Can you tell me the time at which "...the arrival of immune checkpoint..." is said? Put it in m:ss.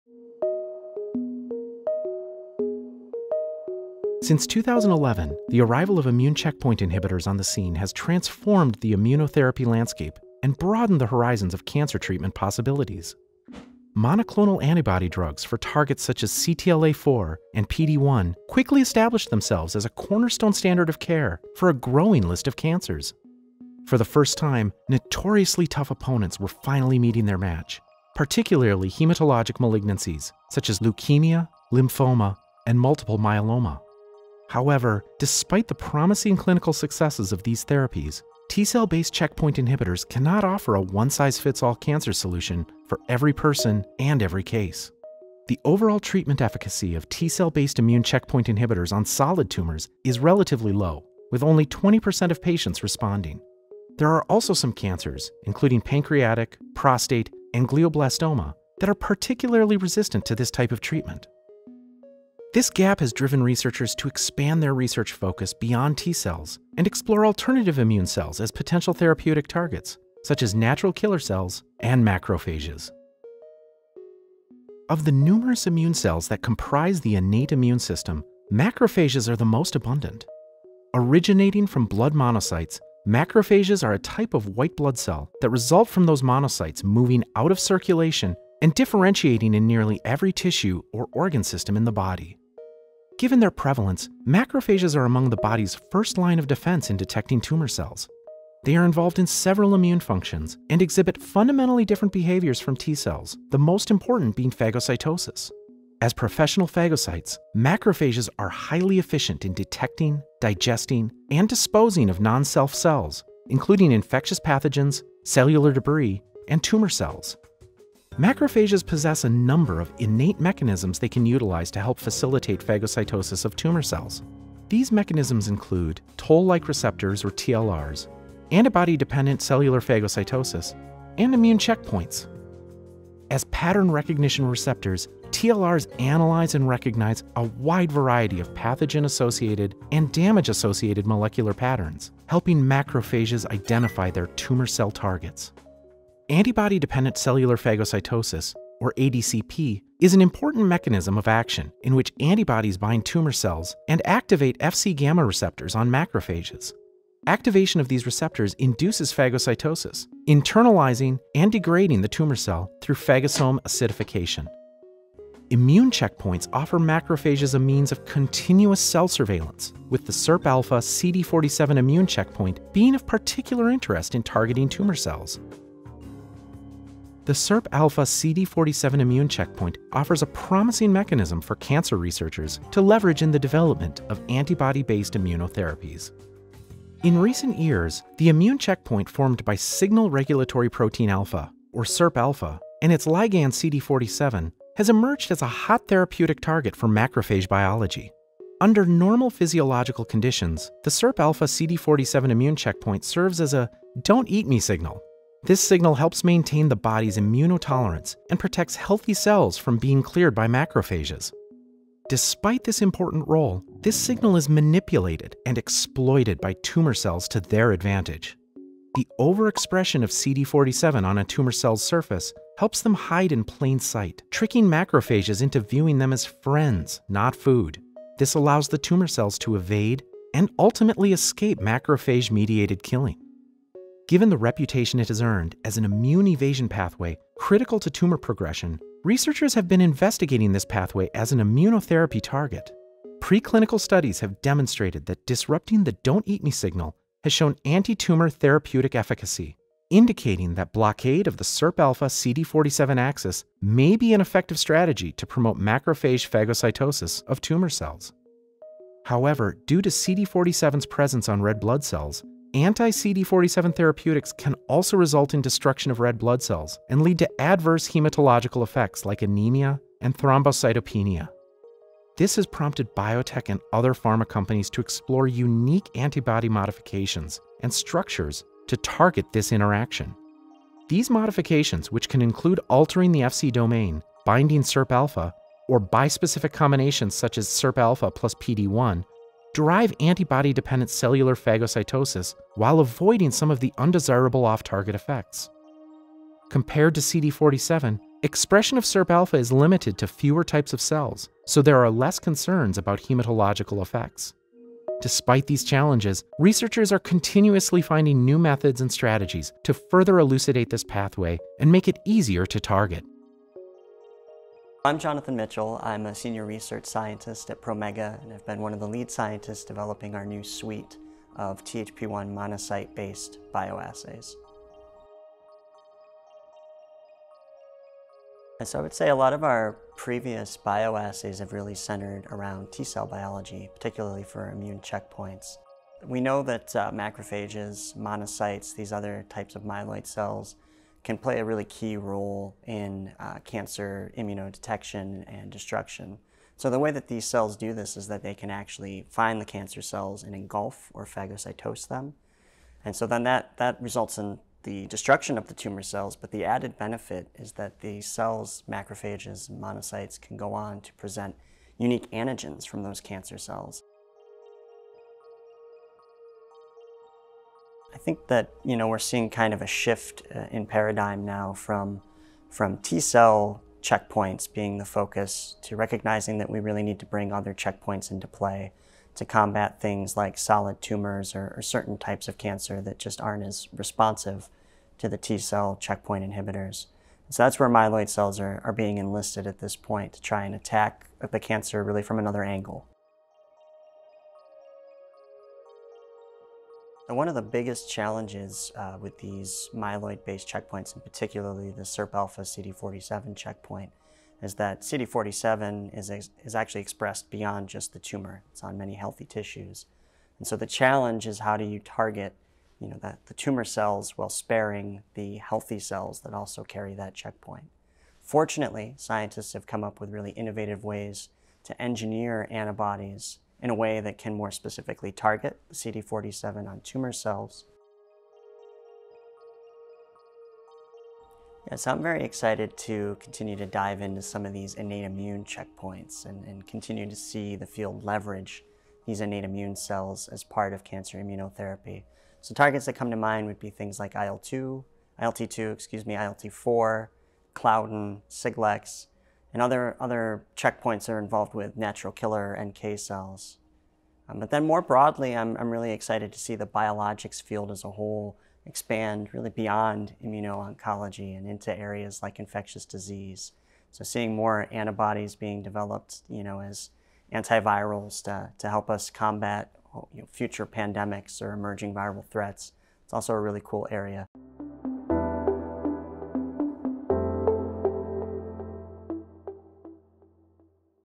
0:05.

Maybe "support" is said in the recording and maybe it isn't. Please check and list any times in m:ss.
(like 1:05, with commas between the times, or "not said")
not said.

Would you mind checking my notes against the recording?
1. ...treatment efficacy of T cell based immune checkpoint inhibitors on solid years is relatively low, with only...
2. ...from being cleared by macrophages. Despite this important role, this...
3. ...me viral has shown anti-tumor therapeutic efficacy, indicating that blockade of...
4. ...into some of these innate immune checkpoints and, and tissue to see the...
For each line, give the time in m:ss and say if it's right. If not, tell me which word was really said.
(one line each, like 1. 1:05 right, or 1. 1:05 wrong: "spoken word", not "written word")
1. 0:46 wrong: "tumors", not "years"
2. 3:29 right
3. 4:06 wrong: "signal", not "viral"
4. 7:14 wrong: "continue", not "tissue".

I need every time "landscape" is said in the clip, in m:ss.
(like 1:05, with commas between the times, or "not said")
0:09.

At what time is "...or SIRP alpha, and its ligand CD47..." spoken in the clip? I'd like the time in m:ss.
3:11.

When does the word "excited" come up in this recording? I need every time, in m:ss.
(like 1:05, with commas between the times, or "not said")
7:12, 7:35.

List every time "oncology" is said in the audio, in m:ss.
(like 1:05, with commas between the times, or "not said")
7:40.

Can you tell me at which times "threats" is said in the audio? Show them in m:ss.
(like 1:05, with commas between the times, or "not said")
7:52.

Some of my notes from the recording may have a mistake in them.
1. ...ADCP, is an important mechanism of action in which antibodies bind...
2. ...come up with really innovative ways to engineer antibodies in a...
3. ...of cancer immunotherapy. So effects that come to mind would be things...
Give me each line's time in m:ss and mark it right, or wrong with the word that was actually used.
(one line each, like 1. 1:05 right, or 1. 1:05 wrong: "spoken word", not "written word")
1. 2:28 right
2. 6:59 right
3. 7:20 wrong: "targets", not "effects".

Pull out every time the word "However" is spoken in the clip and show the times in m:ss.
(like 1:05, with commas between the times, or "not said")
0:34, 4:19.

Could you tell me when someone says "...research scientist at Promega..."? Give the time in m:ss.
5:16.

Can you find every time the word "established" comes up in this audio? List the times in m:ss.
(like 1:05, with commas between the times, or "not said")
0:18.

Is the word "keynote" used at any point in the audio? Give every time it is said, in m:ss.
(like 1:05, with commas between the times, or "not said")
not said.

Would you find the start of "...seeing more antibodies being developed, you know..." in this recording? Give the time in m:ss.
7:44.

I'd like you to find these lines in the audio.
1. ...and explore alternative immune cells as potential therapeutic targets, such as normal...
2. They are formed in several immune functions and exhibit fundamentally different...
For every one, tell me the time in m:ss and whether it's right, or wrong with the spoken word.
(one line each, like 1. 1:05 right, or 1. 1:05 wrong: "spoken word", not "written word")
1. 1:06 wrong: "natural", not "normal"
2. 1:38 wrong: "involved", not "formed".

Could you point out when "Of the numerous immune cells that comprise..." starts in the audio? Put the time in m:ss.
1:14.